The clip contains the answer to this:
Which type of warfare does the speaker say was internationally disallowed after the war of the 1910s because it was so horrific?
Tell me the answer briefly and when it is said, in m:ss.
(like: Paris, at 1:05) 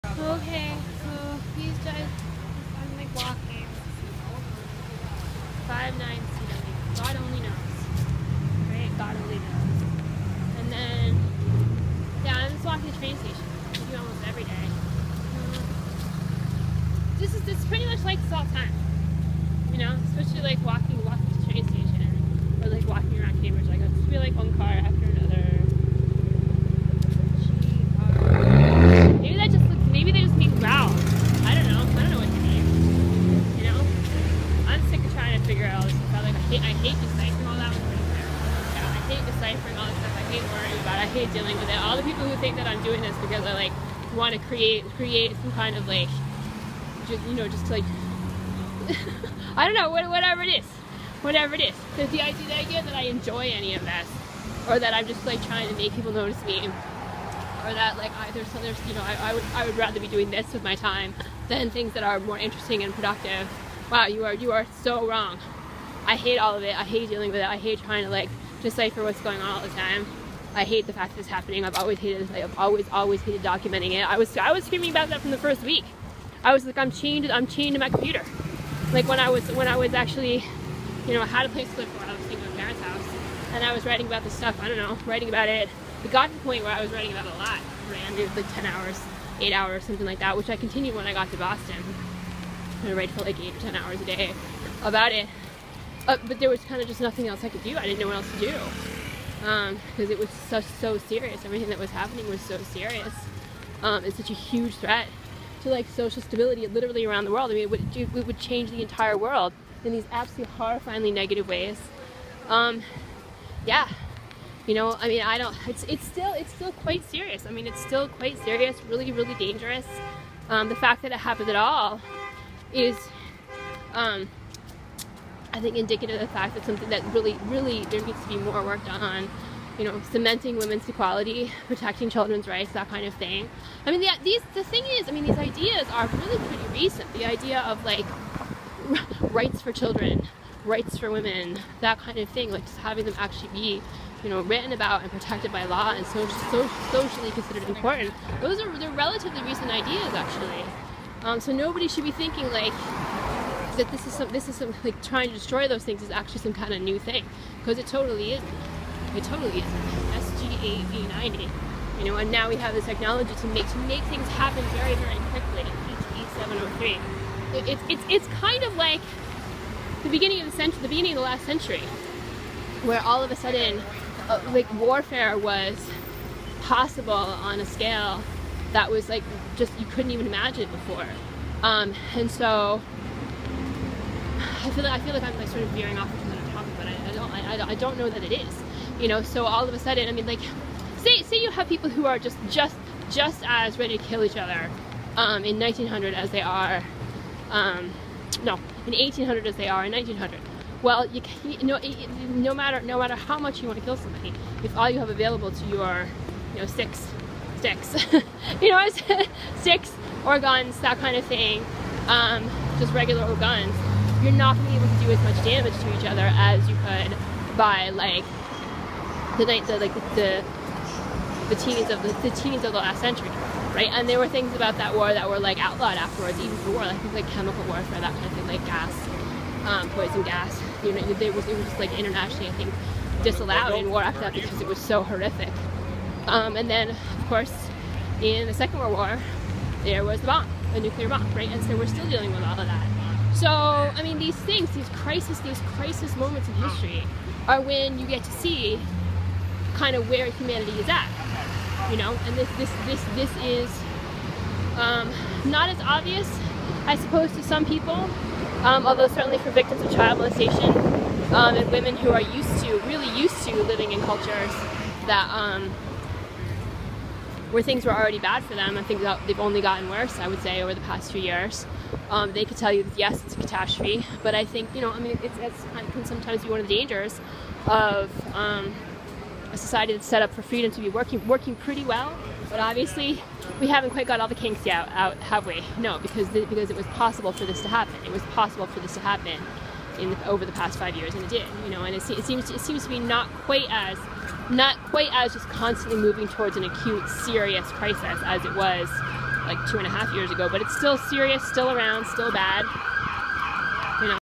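chemical warfare, at 3:47.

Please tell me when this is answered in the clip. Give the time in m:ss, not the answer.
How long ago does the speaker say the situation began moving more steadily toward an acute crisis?
4:59.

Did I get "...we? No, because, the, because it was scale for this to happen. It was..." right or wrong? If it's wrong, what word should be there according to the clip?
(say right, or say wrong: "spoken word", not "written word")
wrong: "possible", not "scale".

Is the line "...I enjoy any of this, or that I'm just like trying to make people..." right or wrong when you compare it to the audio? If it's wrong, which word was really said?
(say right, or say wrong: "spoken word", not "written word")
right.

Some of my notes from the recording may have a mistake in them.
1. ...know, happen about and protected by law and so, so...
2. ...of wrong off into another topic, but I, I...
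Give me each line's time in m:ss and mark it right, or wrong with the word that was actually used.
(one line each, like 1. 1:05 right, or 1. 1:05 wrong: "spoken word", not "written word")
1. 2:24 wrong: "written", not "happen"
2. 3:05 wrong: "veering", not "wrong".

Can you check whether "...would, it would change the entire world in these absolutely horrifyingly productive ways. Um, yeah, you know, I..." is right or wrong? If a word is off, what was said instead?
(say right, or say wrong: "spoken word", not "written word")
wrong: "negative", not "productive".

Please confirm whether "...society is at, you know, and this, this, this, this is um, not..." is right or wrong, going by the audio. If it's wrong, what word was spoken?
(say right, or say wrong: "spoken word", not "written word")
wrong: "humanity", not "society".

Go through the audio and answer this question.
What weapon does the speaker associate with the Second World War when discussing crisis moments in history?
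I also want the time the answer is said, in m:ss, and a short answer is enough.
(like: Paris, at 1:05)
nuclear bomb, at 4:00.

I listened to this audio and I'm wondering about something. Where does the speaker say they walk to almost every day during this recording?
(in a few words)
train station.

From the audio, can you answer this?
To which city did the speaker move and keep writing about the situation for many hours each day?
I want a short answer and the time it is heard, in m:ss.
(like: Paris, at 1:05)
Boston, at 1:31.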